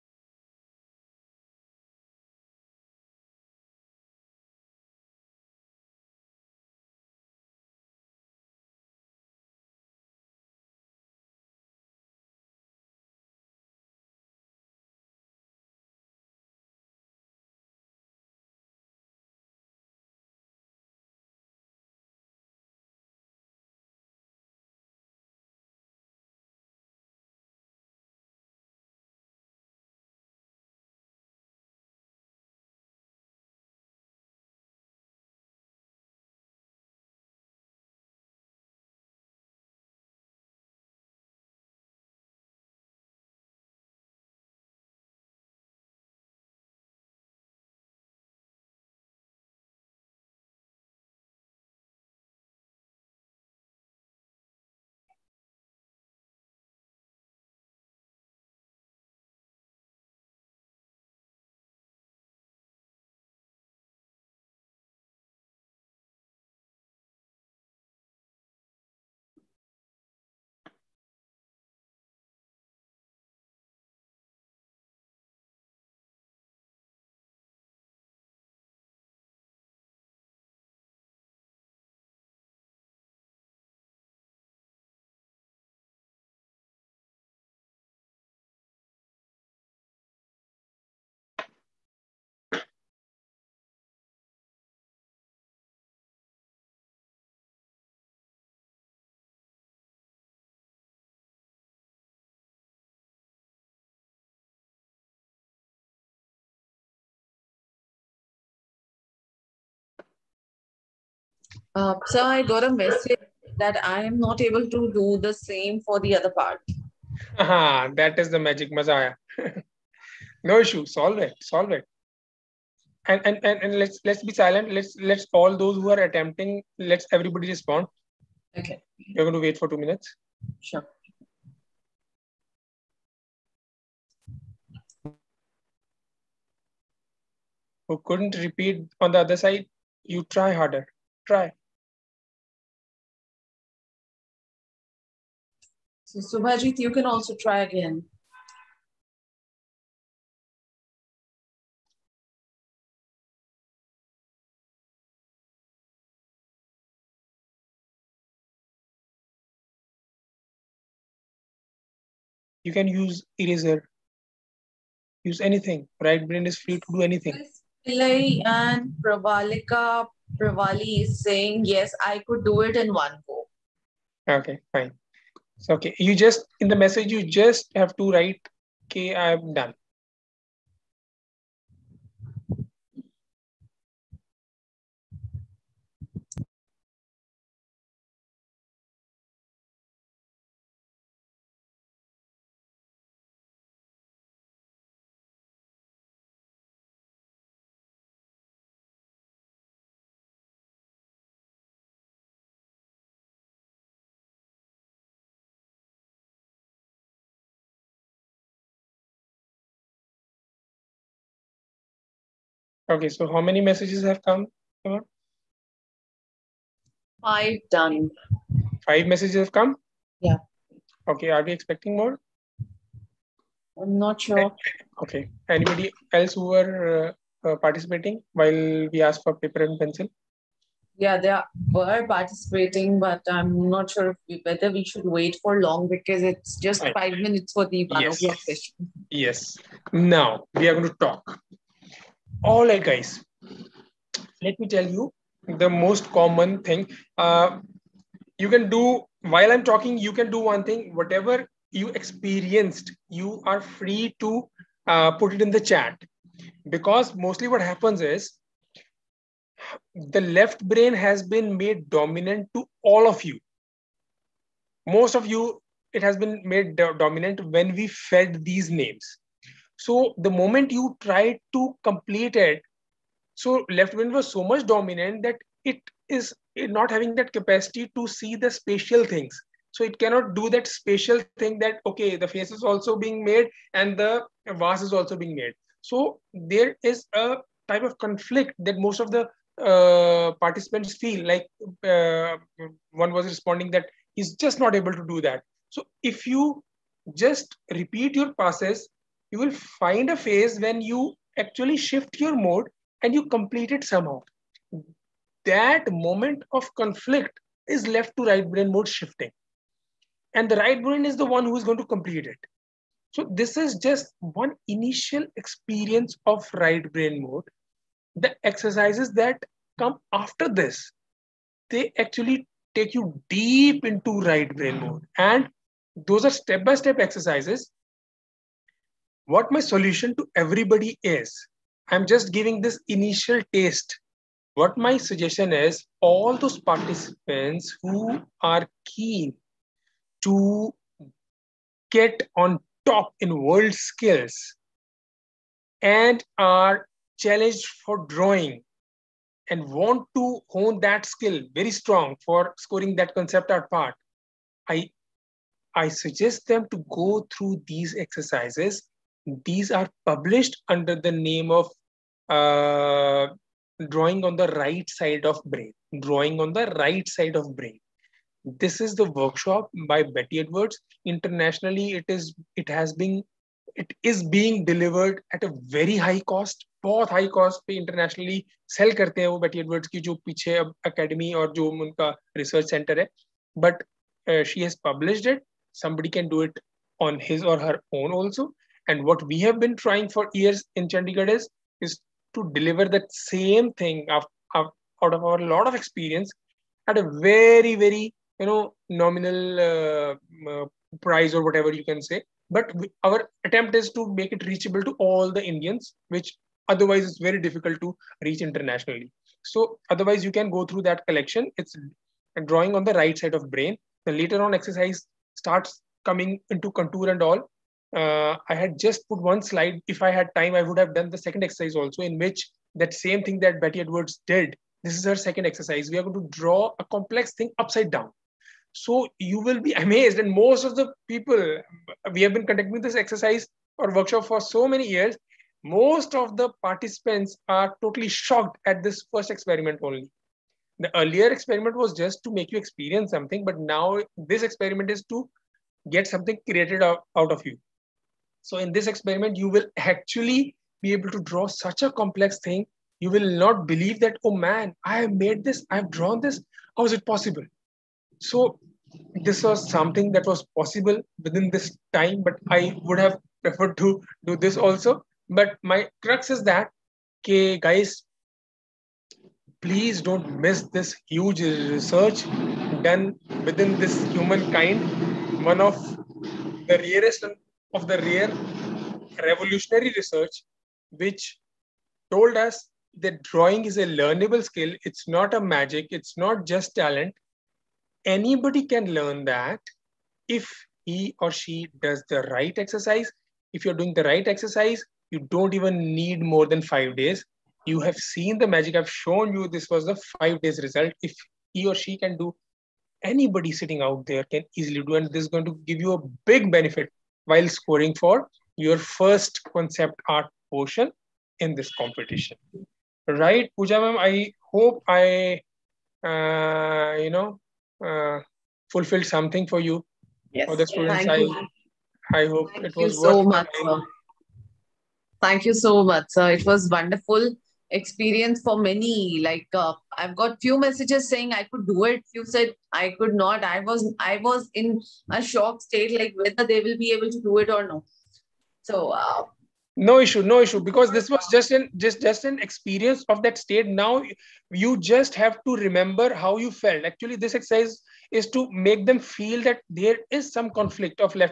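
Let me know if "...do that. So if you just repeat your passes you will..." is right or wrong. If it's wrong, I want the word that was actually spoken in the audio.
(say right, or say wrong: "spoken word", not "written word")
right.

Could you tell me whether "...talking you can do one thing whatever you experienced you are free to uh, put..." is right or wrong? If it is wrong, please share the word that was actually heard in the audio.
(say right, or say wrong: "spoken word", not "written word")
right.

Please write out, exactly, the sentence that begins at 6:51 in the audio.
It's drawing on the right side of brain.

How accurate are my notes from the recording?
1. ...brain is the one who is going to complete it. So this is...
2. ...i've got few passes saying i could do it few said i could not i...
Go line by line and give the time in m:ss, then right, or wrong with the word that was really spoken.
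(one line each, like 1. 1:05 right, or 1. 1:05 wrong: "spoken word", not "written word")
1. 5:10 right
2. 8:49 wrong: "messages", not "passes".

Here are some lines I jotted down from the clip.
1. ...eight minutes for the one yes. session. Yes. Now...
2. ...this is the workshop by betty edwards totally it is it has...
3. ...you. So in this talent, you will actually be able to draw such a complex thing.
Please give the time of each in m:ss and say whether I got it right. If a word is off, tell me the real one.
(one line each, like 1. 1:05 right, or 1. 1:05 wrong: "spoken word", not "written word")
1. 3:56 wrong: "five", not "eight"
2. 6:08 wrong: "internationally", not "totally"
3. 7:27 wrong: "experiment", not "talent".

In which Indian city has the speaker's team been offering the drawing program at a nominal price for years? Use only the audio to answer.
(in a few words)
Chandigarh.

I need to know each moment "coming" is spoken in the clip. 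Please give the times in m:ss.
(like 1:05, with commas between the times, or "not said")
6:56.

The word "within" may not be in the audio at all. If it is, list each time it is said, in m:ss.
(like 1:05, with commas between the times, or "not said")
7:41, 7:53.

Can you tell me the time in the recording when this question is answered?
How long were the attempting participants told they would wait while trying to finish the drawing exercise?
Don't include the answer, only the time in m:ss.
2:09.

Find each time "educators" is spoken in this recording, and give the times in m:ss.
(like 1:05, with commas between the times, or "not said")
not said.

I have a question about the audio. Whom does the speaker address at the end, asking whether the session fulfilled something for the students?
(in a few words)
Pooja.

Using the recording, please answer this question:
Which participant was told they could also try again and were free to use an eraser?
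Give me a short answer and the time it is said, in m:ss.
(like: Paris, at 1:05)
Subhajit, at 2:26.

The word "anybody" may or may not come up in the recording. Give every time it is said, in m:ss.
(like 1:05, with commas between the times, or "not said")
3:45, 8:08, 8:23.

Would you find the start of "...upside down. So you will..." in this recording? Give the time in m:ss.
7:07.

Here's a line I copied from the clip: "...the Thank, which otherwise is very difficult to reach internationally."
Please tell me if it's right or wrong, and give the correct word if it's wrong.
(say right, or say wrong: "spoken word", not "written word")
wrong: "Indians", not "Thank".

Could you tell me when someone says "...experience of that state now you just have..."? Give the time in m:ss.
9:02.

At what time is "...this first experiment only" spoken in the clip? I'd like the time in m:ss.
7:18.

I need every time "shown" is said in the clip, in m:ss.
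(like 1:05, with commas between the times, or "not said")
8:18.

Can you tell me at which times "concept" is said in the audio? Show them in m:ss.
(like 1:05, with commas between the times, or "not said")
5:53, 8:29.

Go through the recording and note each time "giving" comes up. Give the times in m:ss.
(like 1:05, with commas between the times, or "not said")
5:32.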